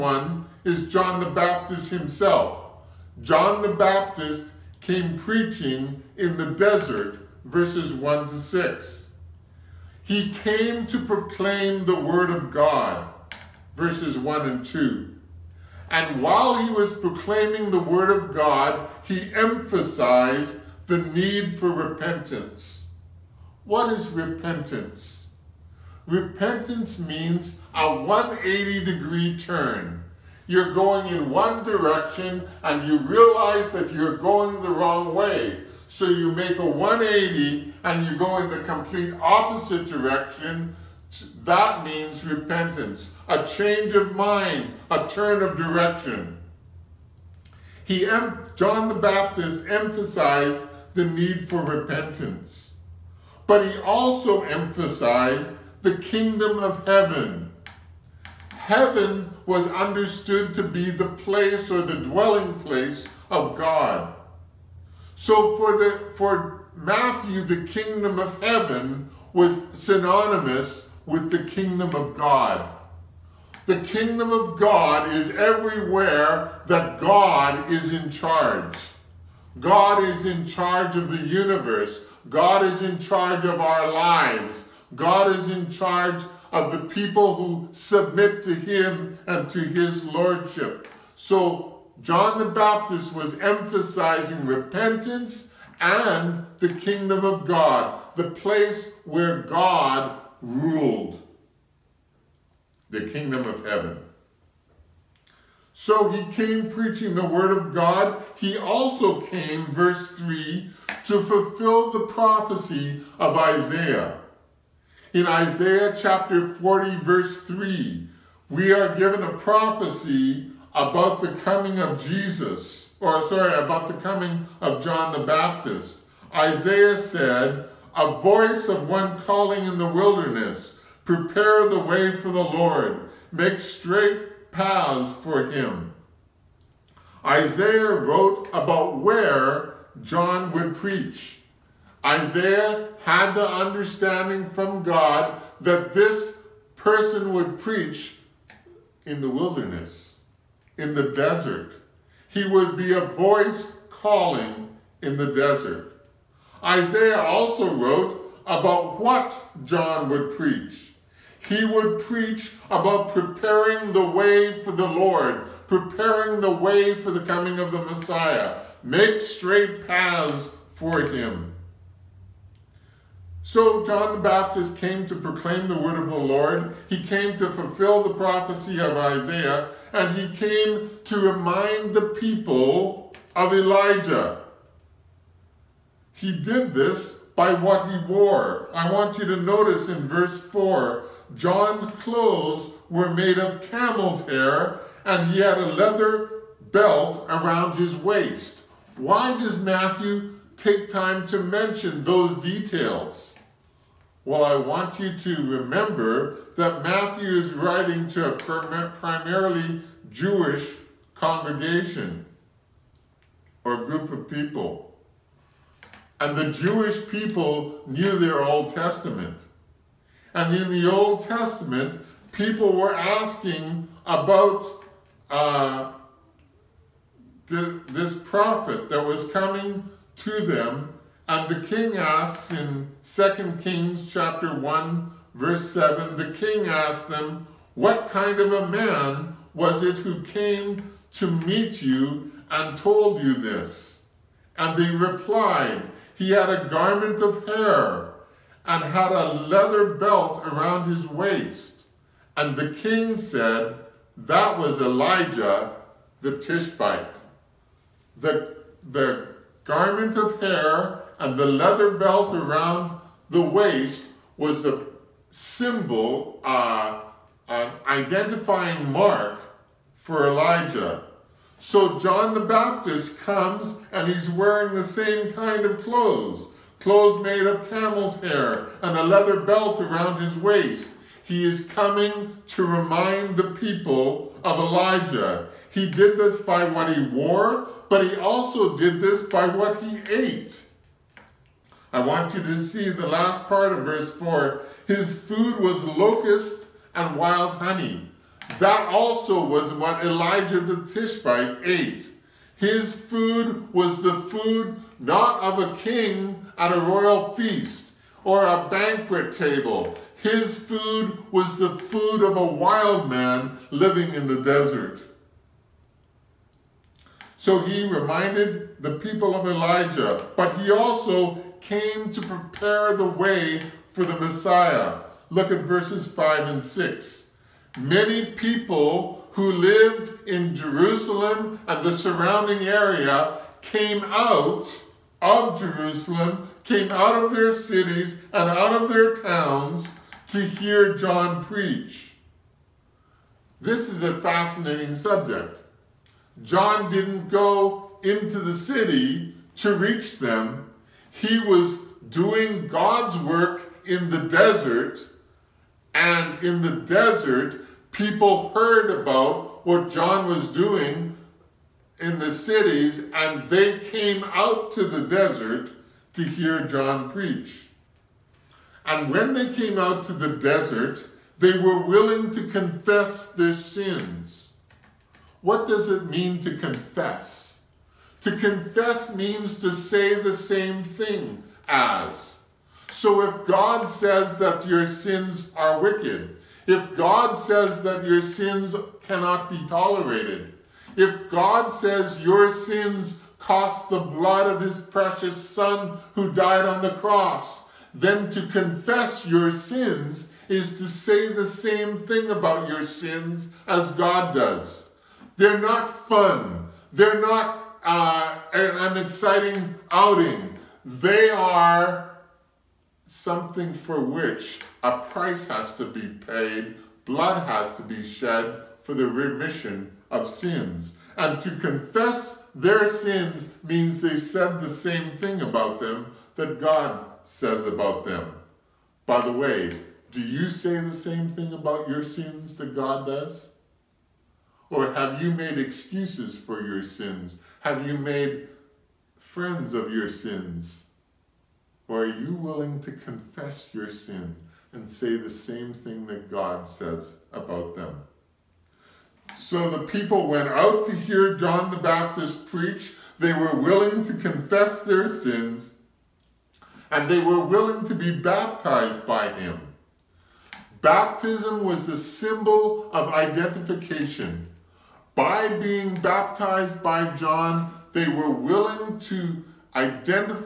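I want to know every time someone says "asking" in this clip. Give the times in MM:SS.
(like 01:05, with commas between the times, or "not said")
03:42.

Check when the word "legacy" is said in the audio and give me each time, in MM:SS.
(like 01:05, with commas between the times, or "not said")
not said.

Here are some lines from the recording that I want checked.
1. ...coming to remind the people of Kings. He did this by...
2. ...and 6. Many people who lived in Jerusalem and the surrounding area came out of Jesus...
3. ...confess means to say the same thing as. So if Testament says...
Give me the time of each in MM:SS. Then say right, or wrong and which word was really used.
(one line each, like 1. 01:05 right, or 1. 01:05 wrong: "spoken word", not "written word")
1. 04:41 wrong: "Elijah", not "Kings"
2. 05:26 wrong: "Jerusalem", not "Jesus"
3. 06:18 wrong: "God", not "Testament".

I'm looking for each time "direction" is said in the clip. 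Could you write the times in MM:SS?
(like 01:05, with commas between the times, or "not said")
00:31, 00:39, 00:45.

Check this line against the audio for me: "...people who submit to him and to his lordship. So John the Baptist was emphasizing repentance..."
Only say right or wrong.
right.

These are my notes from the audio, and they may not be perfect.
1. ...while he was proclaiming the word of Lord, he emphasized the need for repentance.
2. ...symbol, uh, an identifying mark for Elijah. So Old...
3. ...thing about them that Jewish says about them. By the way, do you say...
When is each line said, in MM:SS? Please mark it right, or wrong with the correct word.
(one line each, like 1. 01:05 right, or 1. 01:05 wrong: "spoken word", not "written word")
1. 00:16 wrong: "God", not "Lord"
2. 04:25 wrong: "John", not "Old"
3. 07:05 wrong: "God", not "Jewish".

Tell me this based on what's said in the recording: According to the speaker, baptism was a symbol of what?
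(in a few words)
Identification.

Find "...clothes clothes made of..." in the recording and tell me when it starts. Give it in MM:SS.
04:35.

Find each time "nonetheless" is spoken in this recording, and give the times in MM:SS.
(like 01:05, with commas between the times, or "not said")
not said.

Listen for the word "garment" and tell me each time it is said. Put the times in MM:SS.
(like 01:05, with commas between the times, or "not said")
04:06, 04:19.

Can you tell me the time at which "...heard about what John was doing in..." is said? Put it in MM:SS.
05:58.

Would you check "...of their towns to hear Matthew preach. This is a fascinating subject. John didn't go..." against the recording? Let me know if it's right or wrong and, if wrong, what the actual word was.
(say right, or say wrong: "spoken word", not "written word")
wrong: "John", not "Matthew".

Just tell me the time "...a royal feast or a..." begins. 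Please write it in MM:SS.
05:06.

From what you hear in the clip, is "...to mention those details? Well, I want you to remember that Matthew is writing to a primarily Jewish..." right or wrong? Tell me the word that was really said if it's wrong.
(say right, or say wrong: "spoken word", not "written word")
right.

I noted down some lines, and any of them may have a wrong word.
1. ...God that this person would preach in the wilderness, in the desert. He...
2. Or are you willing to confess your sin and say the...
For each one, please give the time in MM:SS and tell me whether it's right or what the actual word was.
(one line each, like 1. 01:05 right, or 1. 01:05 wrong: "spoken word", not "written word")
1. 02:24 right
2. 07:21 right.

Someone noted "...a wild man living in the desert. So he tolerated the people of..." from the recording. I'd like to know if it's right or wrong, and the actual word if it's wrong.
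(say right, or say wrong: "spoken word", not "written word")
wrong: "reminded", not "tolerated".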